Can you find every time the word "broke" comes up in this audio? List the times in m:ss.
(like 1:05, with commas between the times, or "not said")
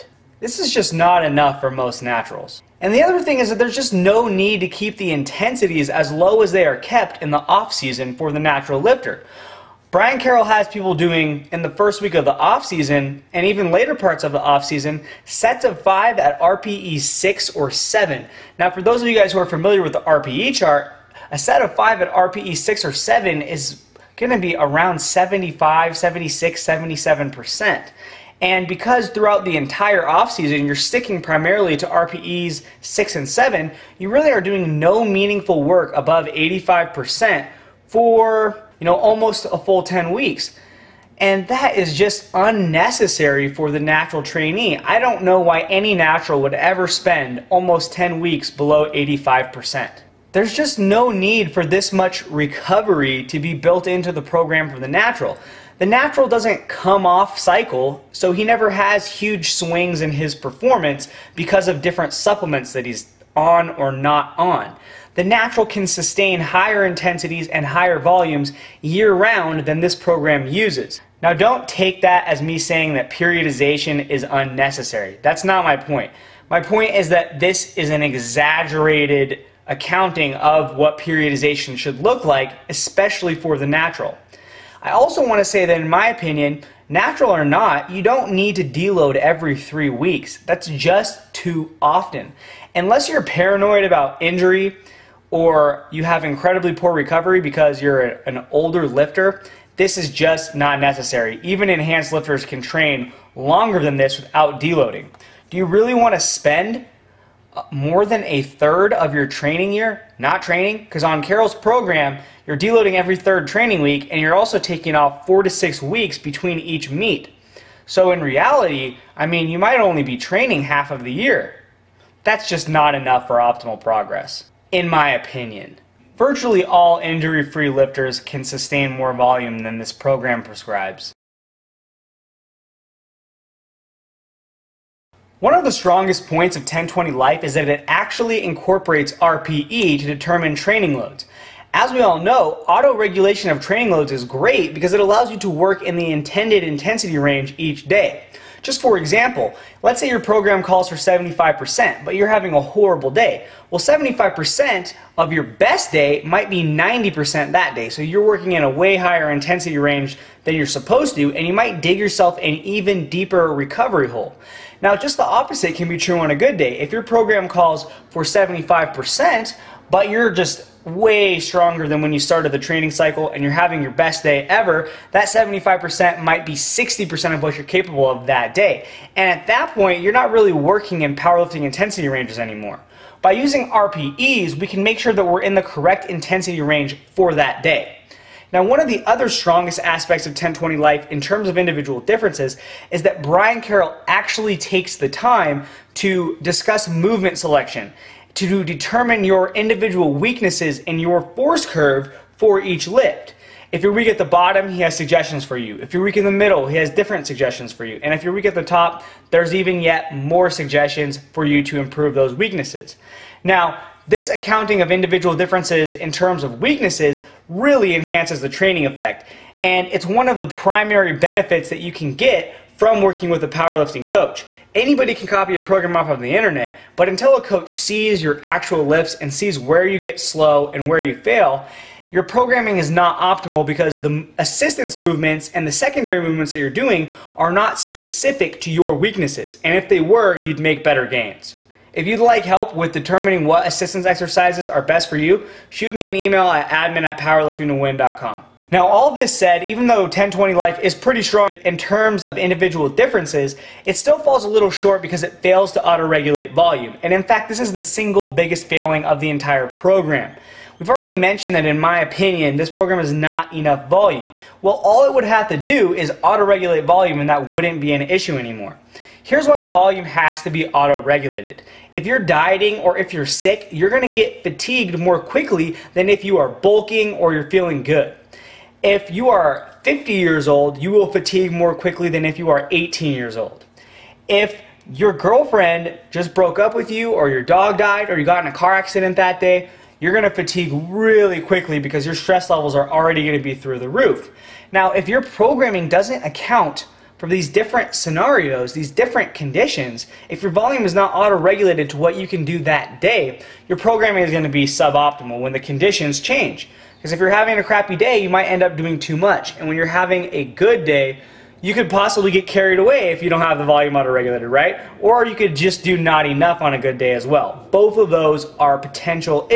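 4:46.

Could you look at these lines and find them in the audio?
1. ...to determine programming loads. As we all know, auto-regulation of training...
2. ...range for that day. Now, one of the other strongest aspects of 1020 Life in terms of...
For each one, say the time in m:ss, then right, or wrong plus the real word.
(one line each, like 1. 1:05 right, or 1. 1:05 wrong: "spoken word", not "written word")
1. 2:19 wrong: "training", not "programming"
2. 3:06 right.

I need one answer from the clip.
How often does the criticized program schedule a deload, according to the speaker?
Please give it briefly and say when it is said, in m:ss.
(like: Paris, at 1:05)
Every three weeks, at 1:29.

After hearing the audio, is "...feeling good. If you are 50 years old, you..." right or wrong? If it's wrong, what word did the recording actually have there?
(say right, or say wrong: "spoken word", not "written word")
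right.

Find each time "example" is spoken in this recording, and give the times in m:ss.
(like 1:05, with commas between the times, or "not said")
2:28.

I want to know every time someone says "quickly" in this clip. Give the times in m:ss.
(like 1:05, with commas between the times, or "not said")
4:35, 4:41, 4:51.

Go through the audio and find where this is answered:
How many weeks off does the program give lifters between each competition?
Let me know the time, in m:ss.
1:55.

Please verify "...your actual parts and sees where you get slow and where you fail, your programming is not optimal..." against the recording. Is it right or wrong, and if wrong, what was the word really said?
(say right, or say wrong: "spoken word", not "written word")
wrong: "lifts", not "parts".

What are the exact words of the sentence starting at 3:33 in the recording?
Now, this accounting of individual differences in terms of weaknesses really enhances the training effect.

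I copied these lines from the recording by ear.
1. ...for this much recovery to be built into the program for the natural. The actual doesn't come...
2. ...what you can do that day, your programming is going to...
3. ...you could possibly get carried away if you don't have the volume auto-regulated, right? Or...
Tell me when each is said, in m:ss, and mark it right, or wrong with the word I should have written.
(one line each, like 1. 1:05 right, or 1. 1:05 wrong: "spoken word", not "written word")
1. 0:51 wrong: "natural", not "actual"
2. 5:01 right
3. 5:11 right.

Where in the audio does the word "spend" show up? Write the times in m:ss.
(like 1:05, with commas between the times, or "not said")
0:46, 1:46.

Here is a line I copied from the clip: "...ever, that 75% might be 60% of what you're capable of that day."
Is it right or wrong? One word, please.
right.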